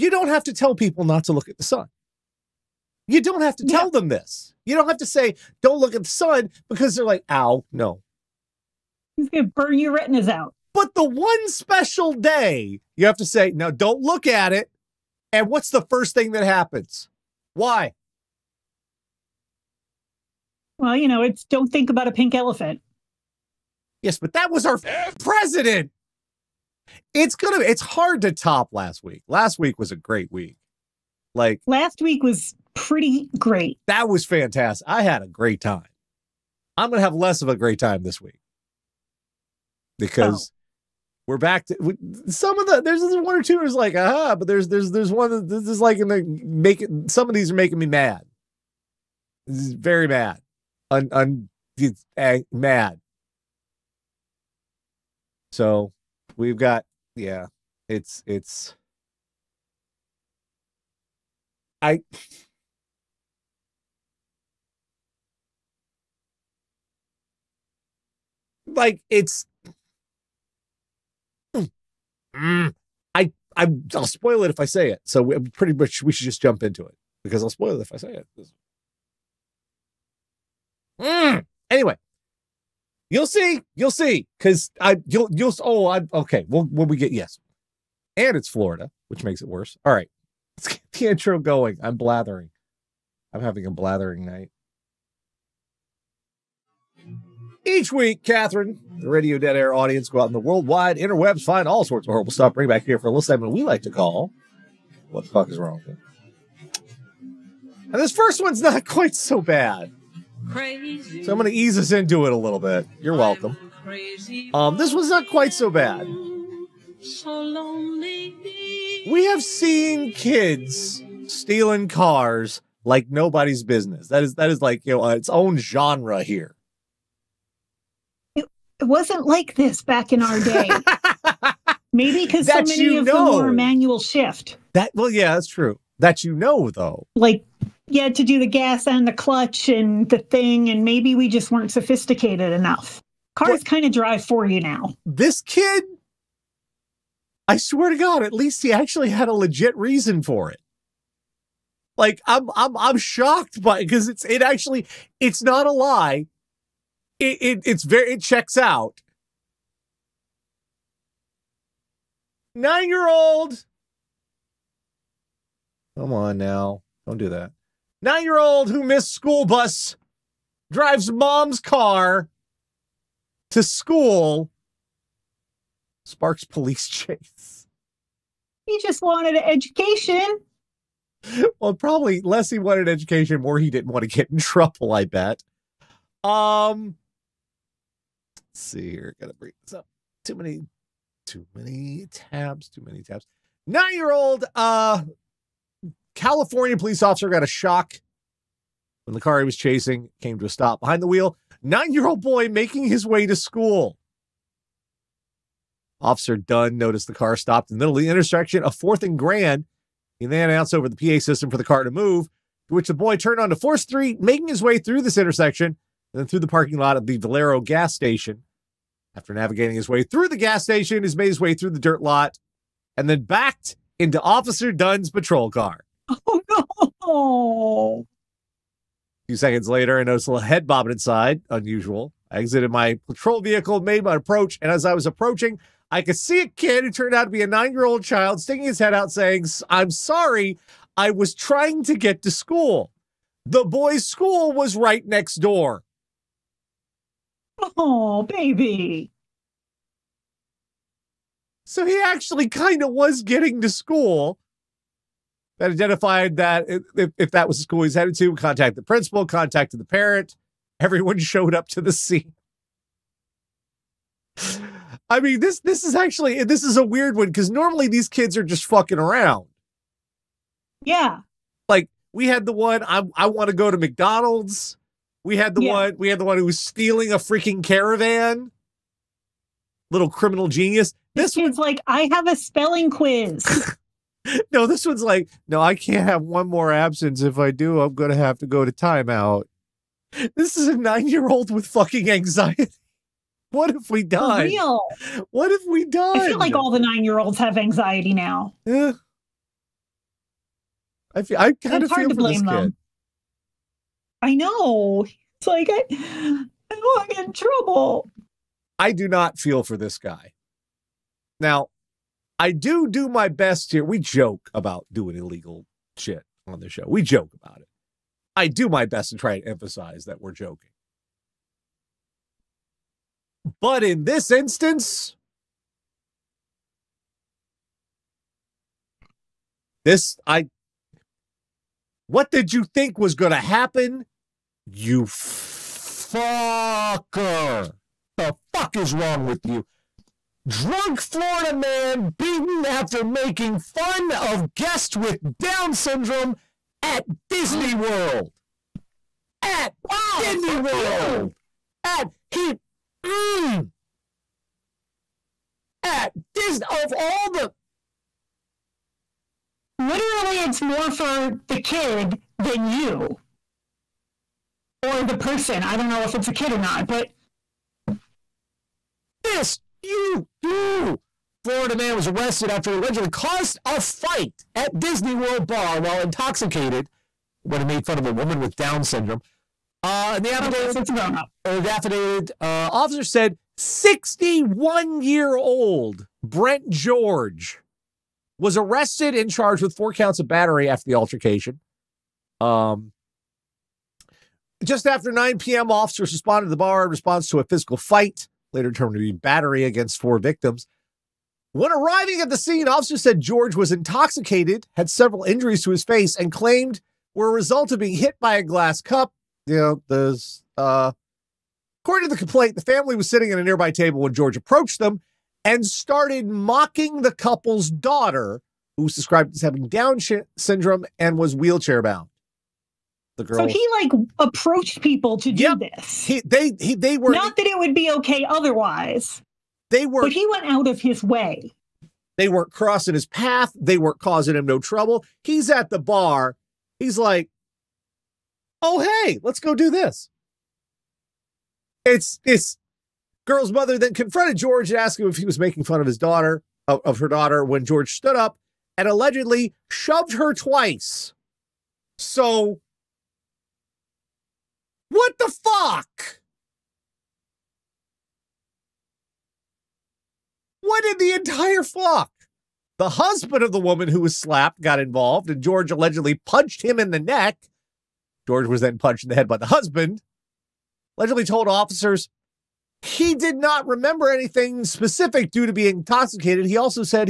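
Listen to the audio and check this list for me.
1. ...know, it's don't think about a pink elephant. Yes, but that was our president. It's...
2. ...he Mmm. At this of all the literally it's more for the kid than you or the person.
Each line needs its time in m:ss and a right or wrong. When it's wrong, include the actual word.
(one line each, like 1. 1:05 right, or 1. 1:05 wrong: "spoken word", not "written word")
1. 0:21 right
2. 5:52 right.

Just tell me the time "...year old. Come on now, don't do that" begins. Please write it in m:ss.
2:42.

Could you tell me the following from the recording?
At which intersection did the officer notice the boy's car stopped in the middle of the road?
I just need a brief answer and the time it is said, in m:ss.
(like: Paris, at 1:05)
Fourth and Grand, at 3:28.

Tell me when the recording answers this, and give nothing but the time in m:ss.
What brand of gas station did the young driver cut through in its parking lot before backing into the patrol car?
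3:37.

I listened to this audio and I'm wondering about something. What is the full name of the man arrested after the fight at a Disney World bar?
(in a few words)
Brent George.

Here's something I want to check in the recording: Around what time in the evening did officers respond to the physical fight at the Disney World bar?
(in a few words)
9 p.m.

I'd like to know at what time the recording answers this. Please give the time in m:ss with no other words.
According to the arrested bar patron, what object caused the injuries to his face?
6:48.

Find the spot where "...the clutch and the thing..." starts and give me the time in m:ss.
2:19.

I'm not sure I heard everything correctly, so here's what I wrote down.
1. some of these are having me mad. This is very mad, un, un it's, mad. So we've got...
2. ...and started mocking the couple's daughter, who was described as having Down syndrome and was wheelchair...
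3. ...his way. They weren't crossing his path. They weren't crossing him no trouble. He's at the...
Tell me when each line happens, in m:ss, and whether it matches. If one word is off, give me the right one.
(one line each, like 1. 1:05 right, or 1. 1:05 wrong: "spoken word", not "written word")
1. 0:47 wrong: "making", not "having"
2. 6:55 right
3. 7:10 wrong: "causing", not "crossing".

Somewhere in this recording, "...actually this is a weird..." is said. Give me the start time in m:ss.
4:25.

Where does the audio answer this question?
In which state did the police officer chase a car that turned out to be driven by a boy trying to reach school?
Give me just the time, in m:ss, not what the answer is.
3:16.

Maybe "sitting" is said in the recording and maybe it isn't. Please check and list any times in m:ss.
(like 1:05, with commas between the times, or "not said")
6:53.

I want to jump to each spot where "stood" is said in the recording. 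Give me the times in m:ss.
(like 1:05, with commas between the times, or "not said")
7:27.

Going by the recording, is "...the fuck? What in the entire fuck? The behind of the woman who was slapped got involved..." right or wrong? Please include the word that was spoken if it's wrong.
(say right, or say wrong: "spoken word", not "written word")
wrong: "husband", not "behind".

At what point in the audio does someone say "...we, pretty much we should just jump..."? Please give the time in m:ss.
1:15.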